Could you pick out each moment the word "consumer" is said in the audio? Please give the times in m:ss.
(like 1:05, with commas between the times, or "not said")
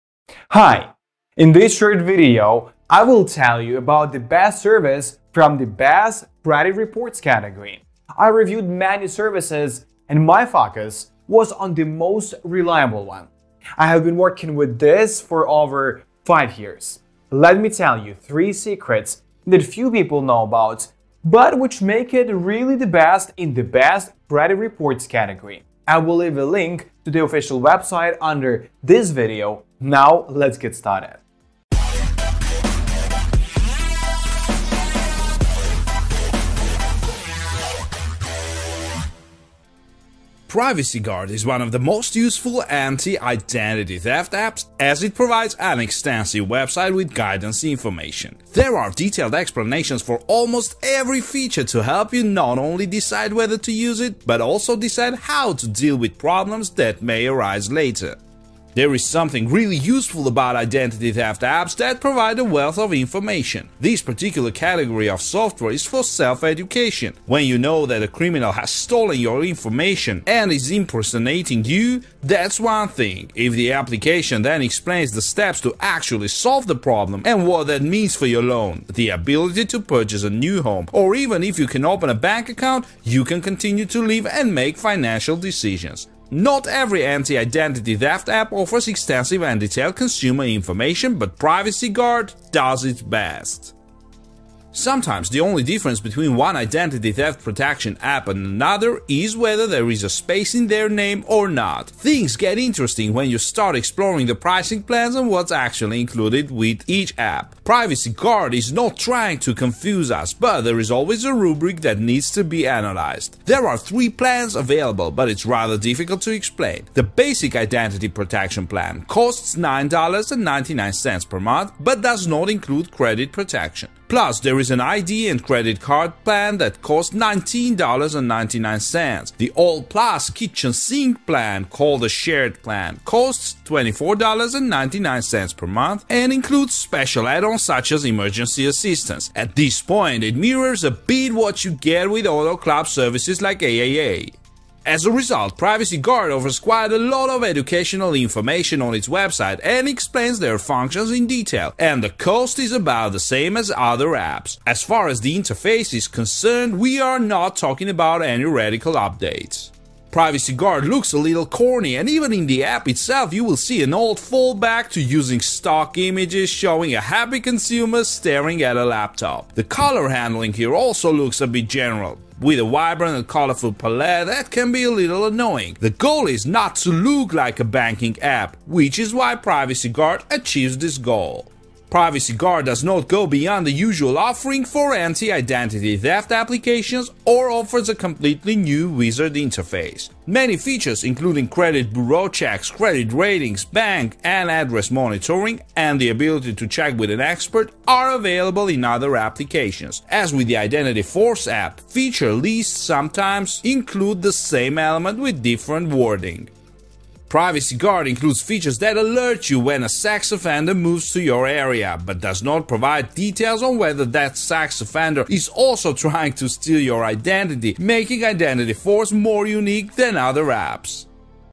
1:29, 2:47.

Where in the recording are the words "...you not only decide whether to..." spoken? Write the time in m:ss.
0:52.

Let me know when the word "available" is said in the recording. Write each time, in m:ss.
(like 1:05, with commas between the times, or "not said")
1:54, 3:18.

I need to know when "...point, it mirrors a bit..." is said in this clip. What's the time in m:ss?
2:19.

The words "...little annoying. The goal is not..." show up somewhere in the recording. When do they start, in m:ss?
2:54.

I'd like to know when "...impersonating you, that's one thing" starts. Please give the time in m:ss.
1:10.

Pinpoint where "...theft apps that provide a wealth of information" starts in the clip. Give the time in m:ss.
1:01.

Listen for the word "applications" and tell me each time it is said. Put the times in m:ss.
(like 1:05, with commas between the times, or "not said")
1:13, 3:06, 3:19.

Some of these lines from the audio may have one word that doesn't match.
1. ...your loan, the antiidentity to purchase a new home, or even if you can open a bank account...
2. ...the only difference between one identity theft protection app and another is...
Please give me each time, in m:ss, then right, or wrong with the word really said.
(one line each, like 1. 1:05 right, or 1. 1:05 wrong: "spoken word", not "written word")
1. 1:18 wrong: "ability", not "antiidentity"
2. 1:35 right.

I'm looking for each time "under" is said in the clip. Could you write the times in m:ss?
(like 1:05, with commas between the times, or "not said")
0:28.